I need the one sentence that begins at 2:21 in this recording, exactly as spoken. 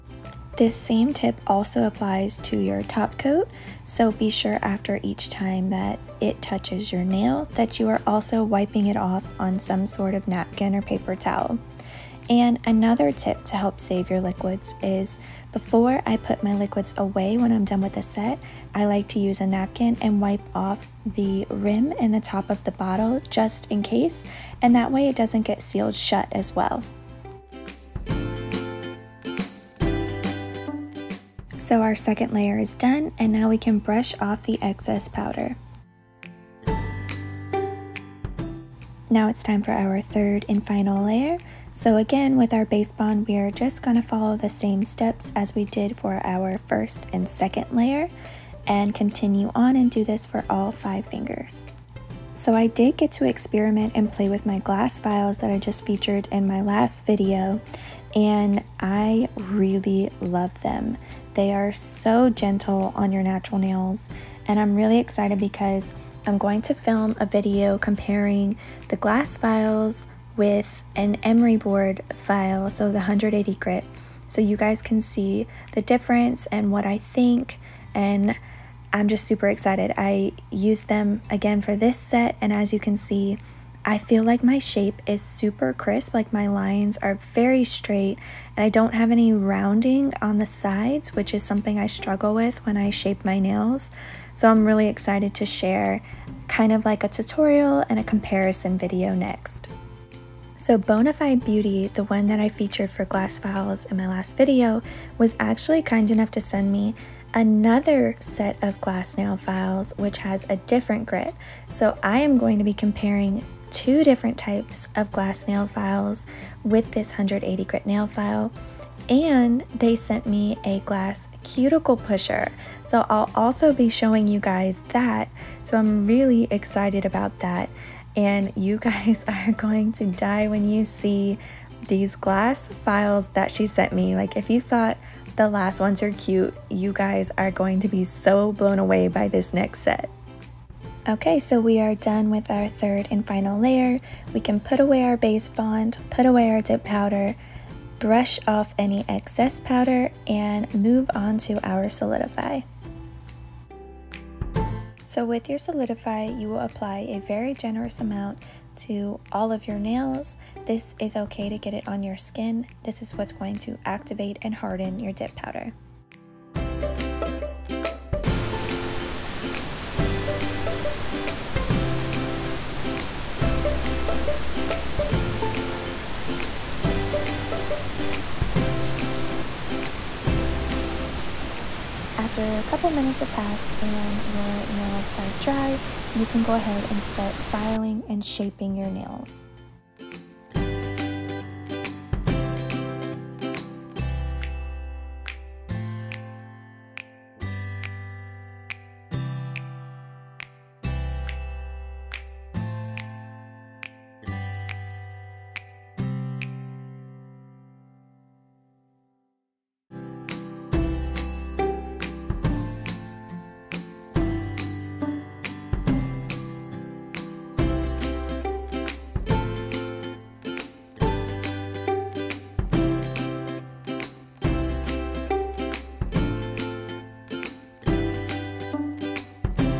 Okay, so we are done with our third and final layer.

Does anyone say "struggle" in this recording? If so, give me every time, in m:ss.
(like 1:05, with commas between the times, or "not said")
1:31.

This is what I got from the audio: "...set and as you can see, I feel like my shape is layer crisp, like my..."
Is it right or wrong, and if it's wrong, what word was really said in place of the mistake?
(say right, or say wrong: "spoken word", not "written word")
wrong: "super", not "layer".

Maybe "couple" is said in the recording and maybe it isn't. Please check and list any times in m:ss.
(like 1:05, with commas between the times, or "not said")
3:02.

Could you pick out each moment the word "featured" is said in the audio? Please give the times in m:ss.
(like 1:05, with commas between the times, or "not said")
0:55, 1:42.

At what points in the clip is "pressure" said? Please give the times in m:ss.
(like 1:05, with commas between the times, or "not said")
not said.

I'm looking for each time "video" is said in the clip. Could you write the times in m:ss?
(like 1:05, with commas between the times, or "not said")
0:57, 1:07, 1:38, 1:44.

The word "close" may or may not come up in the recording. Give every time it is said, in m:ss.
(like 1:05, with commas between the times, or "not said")
not said.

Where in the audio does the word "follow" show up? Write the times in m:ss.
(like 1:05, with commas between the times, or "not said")
0:44.